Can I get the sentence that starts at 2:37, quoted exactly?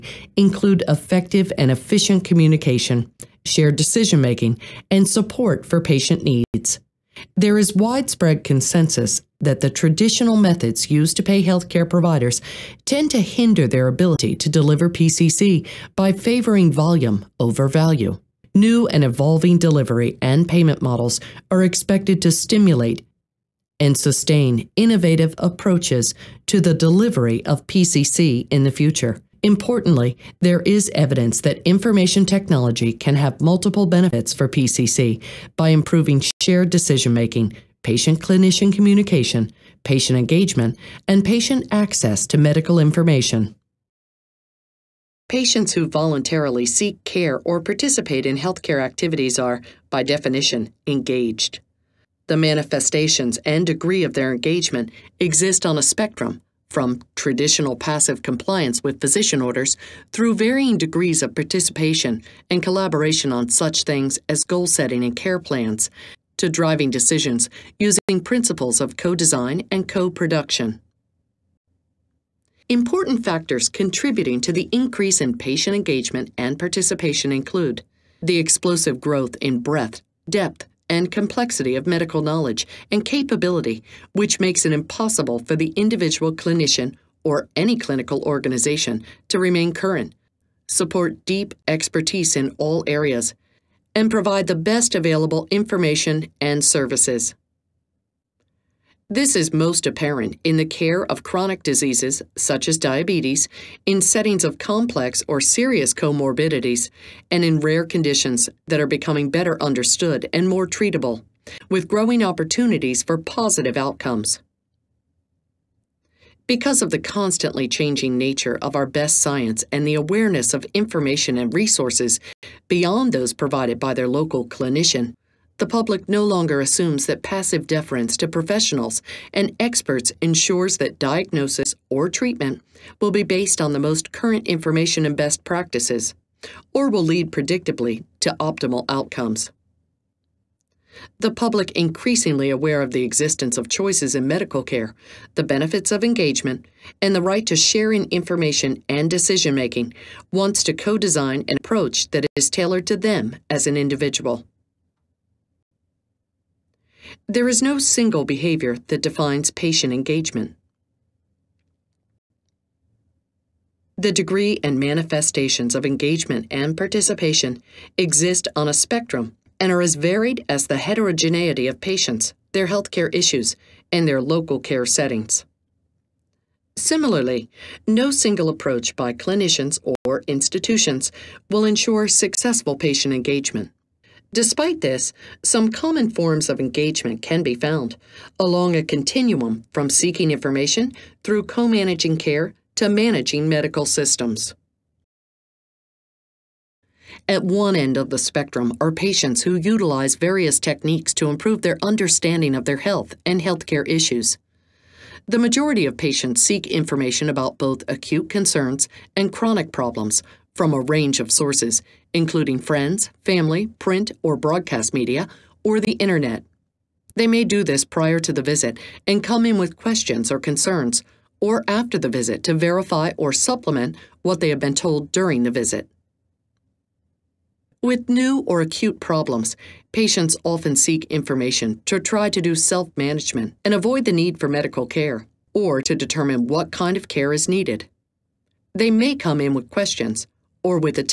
There is no single behavior that defines patient engagement.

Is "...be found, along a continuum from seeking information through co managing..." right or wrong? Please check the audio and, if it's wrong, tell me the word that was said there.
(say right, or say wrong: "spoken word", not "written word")
right.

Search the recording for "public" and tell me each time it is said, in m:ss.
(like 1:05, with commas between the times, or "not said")
2:05, 2:21.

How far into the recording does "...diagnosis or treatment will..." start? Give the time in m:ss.
2:10.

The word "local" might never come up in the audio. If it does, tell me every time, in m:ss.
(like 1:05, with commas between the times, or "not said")
2:04, 2:54.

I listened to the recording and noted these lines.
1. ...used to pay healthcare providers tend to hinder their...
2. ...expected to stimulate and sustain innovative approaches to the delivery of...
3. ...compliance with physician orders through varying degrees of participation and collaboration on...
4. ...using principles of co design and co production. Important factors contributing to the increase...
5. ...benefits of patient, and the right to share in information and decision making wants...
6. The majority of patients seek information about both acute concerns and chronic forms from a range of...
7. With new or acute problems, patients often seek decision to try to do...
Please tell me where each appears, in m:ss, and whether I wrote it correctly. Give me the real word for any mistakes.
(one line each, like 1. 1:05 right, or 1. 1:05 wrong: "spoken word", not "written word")
1. 0:10 right
2. 0:21 right
3. 0:58 right
4. 1:07 right
5. 2:25 wrong: "engagement", not "patient"
6. 3:25 wrong: "problems", not "forms"
7. 3:47 wrong: "information", not "decision".